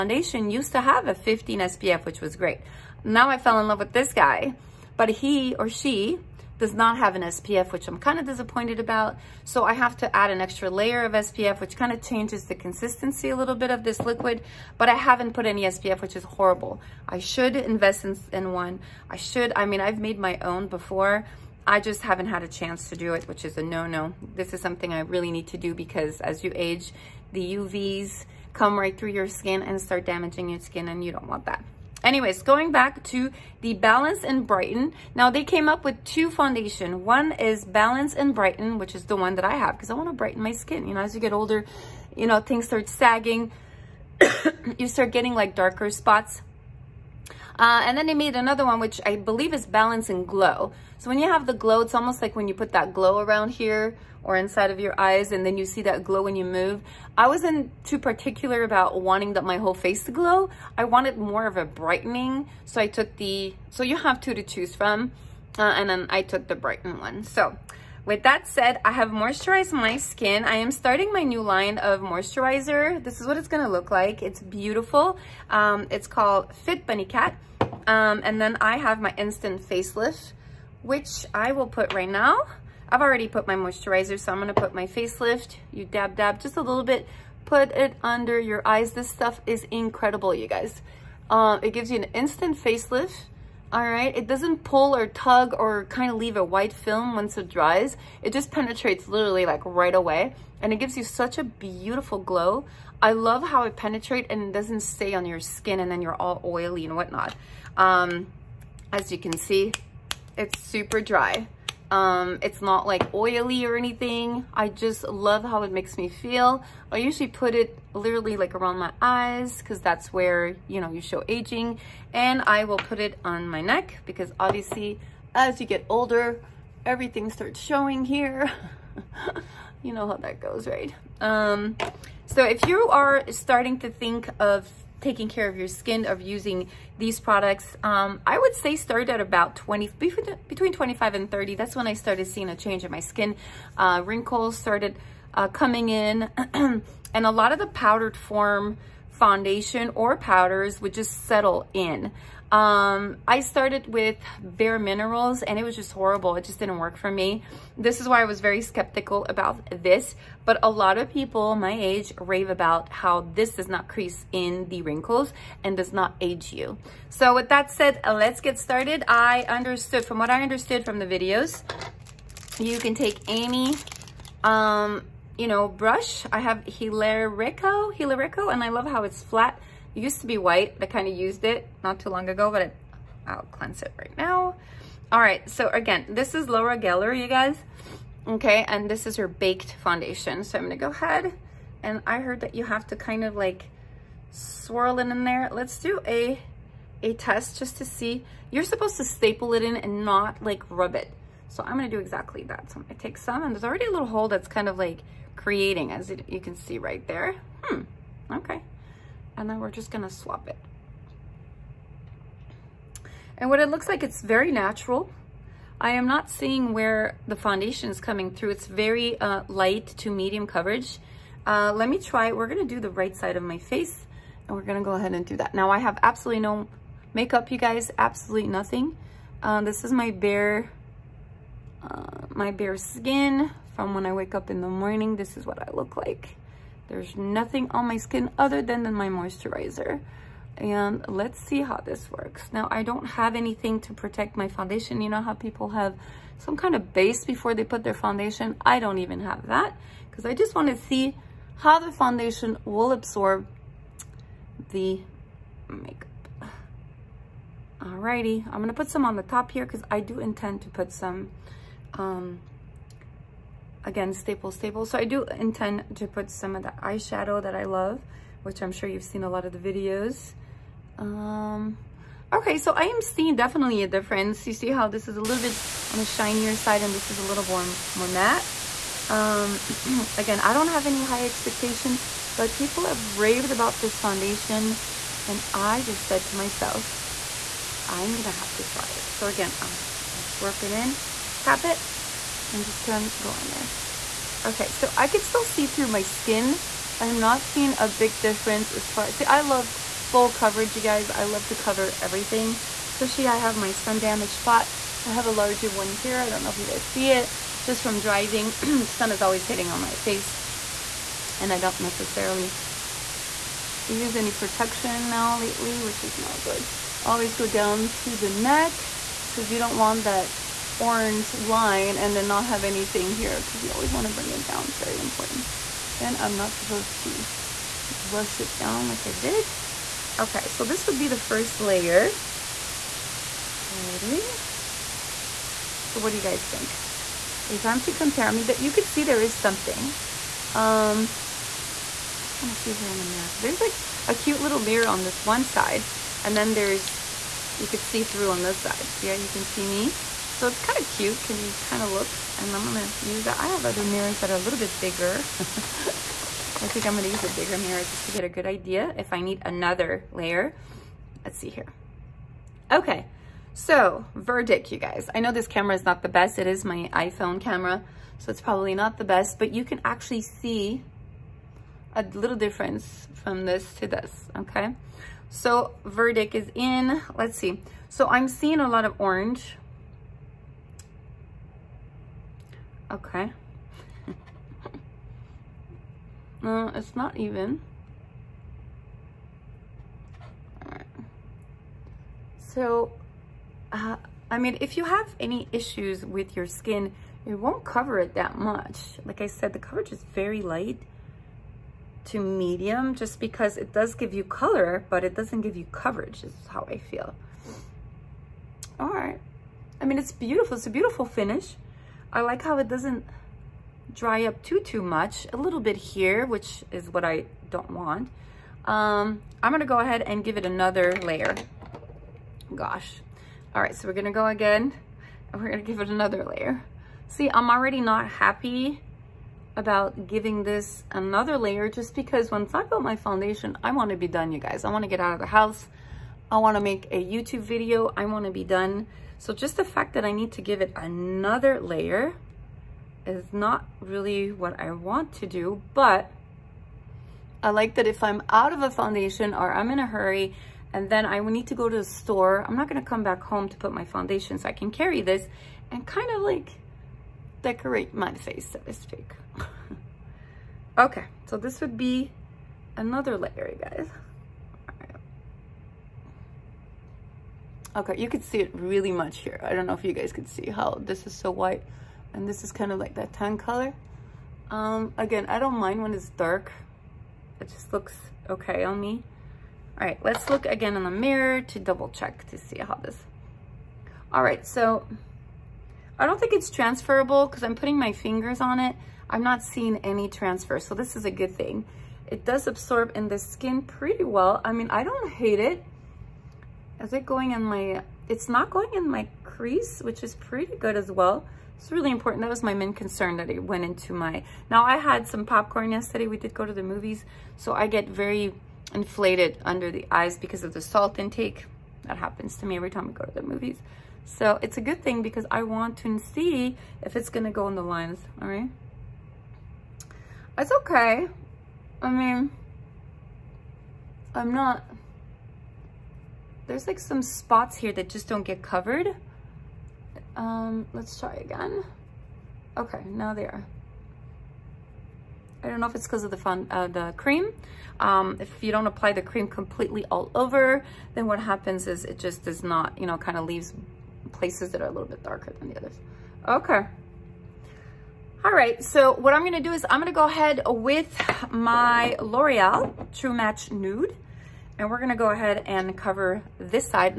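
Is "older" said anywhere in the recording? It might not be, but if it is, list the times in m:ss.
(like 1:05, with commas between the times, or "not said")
0:41, 2:05.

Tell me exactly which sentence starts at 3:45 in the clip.
Now I have absolutely no makeup, you guys, absolutely nothing.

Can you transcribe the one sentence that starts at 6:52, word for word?
I like how it doesn't dry up too, too much.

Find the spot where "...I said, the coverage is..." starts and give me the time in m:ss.
6:39.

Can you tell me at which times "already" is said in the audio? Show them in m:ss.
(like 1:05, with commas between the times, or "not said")
1:23, 3:23, 7:07.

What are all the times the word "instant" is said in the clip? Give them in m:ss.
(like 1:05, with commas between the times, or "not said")
1:19, 1:32.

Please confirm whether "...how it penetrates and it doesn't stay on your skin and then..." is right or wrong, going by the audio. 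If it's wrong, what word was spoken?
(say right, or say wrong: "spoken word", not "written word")
right.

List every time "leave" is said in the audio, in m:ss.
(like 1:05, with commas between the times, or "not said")
1:36, 9:03.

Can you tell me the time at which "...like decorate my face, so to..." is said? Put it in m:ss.
7:36.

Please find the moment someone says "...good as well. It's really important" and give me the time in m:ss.
8:20.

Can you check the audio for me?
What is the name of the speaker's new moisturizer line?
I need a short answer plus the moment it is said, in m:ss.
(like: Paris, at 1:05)
Fit Bunny Cat, at 1:16.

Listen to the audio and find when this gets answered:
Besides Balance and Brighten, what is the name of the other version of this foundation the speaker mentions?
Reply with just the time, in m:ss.
0:49.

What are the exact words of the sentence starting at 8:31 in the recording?
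That happens to me every time we go to the movies.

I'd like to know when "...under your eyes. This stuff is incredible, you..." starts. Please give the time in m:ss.
1:28.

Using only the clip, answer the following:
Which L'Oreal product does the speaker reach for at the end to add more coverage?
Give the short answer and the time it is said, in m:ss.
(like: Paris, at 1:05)
True Match Nude, at 9:12.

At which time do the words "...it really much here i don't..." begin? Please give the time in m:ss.
7:48.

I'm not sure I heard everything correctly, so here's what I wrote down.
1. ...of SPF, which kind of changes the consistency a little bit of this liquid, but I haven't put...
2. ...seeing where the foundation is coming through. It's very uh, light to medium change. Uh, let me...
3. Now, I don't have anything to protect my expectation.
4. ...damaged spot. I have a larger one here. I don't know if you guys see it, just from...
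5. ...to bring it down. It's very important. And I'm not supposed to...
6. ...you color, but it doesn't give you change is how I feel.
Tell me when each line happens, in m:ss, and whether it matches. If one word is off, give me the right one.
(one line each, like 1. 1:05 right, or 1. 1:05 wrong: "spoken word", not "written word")
1. 0:11 right
2. 3:36 wrong: "coverage", not "change"
3. 4:02 wrong: "foundation", not "expectation"
4. 5:03 right
5. 5:24 right
6. 6:44 wrong: "coverage", not "change".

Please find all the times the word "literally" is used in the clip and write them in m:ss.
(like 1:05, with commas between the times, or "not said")
1:39, 1:57.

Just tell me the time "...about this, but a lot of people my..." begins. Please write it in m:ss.
2:39.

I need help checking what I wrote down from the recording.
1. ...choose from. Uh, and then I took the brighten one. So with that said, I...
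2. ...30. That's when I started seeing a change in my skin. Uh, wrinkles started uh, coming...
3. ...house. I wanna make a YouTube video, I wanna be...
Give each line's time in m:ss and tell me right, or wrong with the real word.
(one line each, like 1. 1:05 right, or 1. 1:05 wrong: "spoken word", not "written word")
1. 1:04 right
2. 2:21 right
3. 7:15 right.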